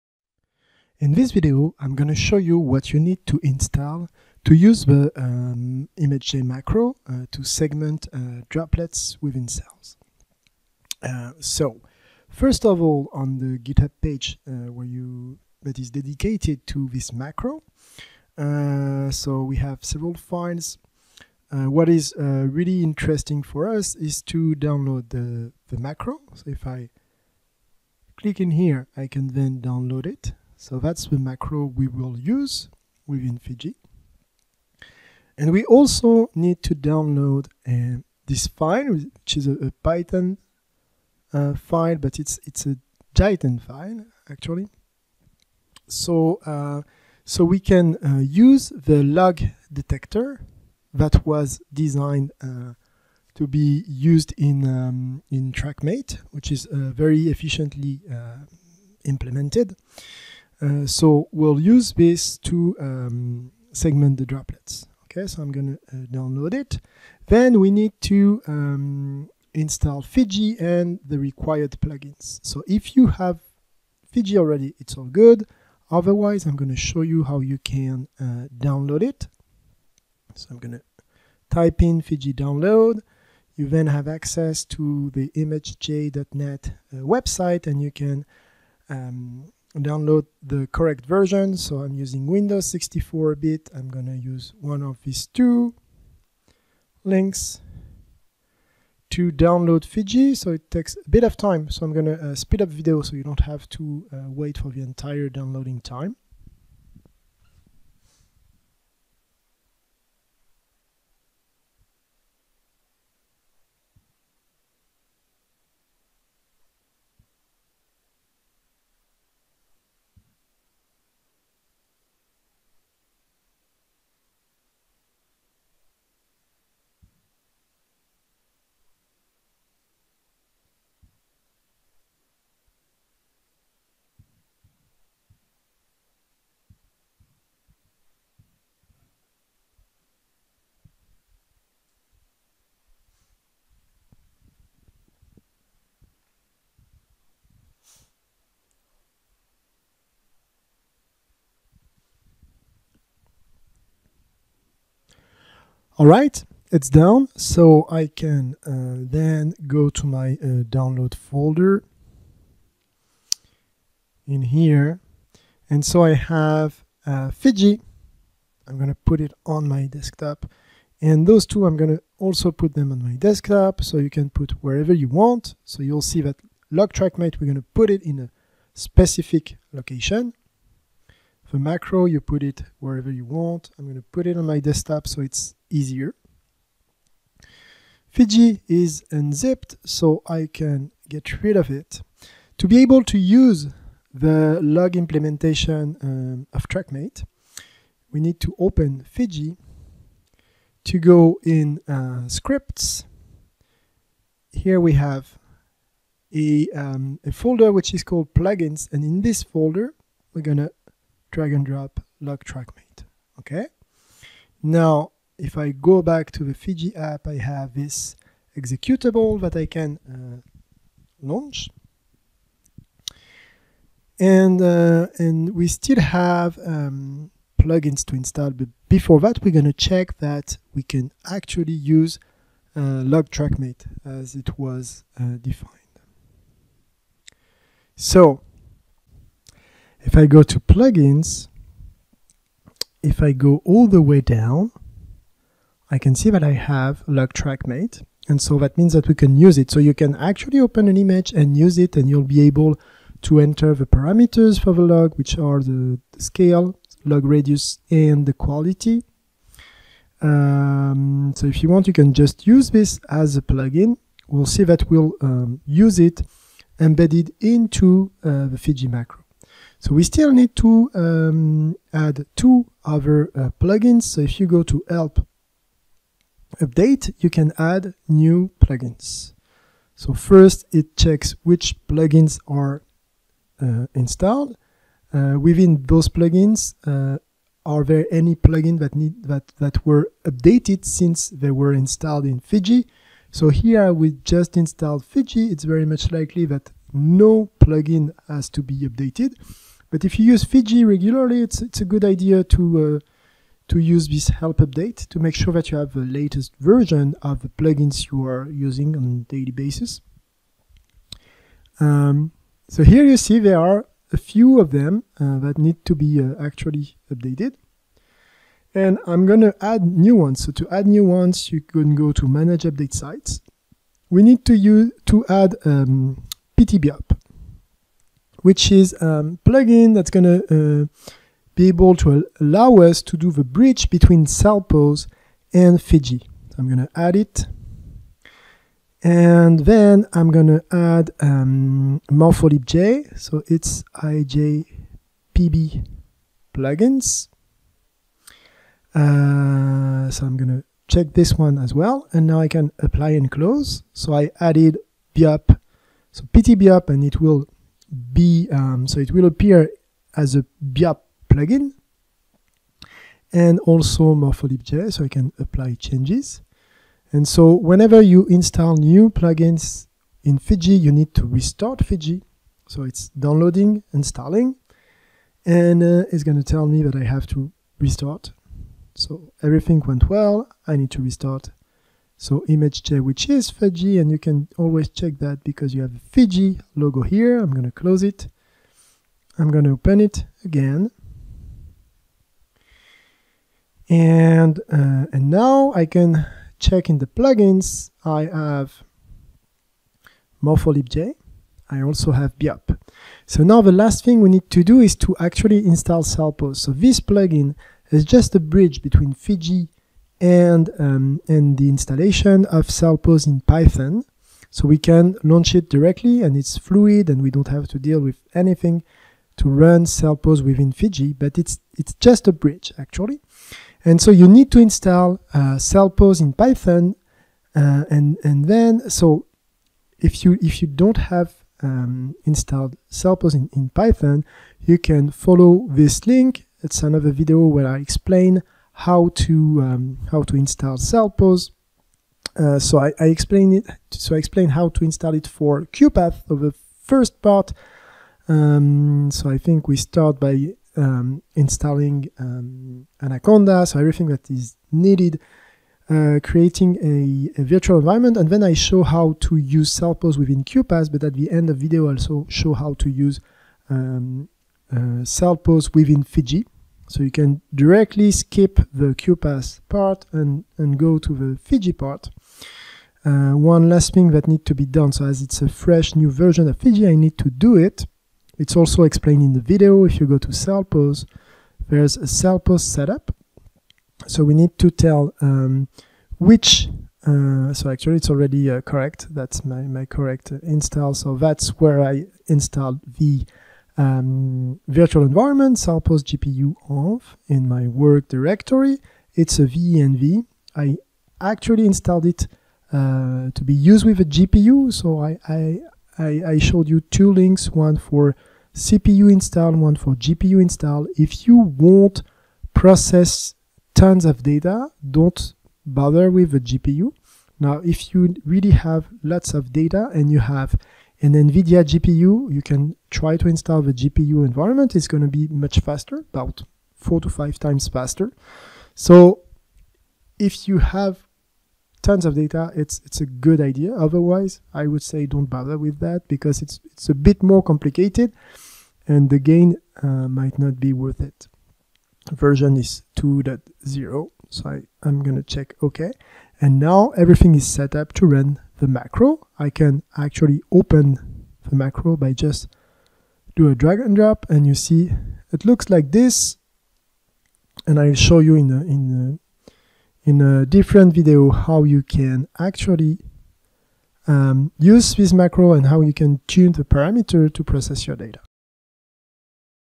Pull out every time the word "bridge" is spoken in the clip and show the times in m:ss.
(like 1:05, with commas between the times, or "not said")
5:33, 6:48, 7:02.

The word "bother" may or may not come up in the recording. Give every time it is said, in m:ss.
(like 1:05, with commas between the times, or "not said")
8:35, 8:55.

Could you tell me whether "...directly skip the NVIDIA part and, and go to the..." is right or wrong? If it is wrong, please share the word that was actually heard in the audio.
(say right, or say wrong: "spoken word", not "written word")
wrong: "QuPath", not "NVIDIA".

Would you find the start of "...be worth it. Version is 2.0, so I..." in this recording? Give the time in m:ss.
9:00.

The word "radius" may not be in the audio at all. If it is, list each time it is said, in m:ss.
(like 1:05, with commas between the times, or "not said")
4:17.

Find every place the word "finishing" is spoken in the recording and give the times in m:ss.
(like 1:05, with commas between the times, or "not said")
not said.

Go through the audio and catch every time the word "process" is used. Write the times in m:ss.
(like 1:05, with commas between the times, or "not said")
8:32, 9:27.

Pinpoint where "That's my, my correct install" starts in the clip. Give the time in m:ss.
8:09.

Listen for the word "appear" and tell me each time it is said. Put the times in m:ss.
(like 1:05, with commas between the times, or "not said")
5:59.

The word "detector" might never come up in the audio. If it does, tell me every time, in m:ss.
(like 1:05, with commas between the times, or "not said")
0:49.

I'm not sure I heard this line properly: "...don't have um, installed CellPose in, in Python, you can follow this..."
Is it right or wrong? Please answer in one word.
right.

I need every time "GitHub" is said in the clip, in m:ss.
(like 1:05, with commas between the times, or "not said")
0:13.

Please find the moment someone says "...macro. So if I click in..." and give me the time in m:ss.
0:25.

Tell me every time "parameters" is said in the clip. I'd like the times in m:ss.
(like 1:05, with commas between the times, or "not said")
4:13, 9:26.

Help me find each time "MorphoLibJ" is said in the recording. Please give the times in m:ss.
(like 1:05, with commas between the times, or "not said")
6:04, 6:40.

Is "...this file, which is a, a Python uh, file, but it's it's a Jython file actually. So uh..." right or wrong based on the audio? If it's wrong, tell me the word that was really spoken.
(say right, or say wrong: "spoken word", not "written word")
right.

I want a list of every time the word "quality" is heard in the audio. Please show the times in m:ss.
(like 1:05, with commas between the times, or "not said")
4:18.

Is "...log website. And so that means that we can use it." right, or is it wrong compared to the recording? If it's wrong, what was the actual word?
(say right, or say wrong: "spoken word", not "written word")
wrong: "trackmate", not "website".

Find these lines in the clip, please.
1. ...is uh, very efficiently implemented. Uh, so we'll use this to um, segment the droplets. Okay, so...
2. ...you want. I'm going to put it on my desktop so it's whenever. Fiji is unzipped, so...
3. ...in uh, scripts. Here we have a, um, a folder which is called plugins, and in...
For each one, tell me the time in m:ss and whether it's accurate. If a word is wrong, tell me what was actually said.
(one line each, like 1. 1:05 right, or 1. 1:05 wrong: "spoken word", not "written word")
1. 0:56 right
2. 3:03 wrong: "easier", not "whenever"
3. 3:21 right.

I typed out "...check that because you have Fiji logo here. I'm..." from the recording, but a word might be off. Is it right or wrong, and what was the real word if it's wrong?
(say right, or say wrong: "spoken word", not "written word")
right.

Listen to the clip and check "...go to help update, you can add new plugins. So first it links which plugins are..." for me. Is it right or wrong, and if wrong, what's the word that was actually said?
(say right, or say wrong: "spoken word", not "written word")
wrong: "checks", not "links".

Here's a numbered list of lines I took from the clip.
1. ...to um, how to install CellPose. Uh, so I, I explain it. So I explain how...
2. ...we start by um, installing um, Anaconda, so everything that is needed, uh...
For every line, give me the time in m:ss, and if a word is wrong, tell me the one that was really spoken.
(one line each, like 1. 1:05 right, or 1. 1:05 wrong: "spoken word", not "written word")
1. 7:19 right
2. 7:29 right.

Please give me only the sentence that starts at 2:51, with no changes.
And those two, I'm going to also put them on my desktop.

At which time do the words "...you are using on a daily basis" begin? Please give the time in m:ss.
5:08.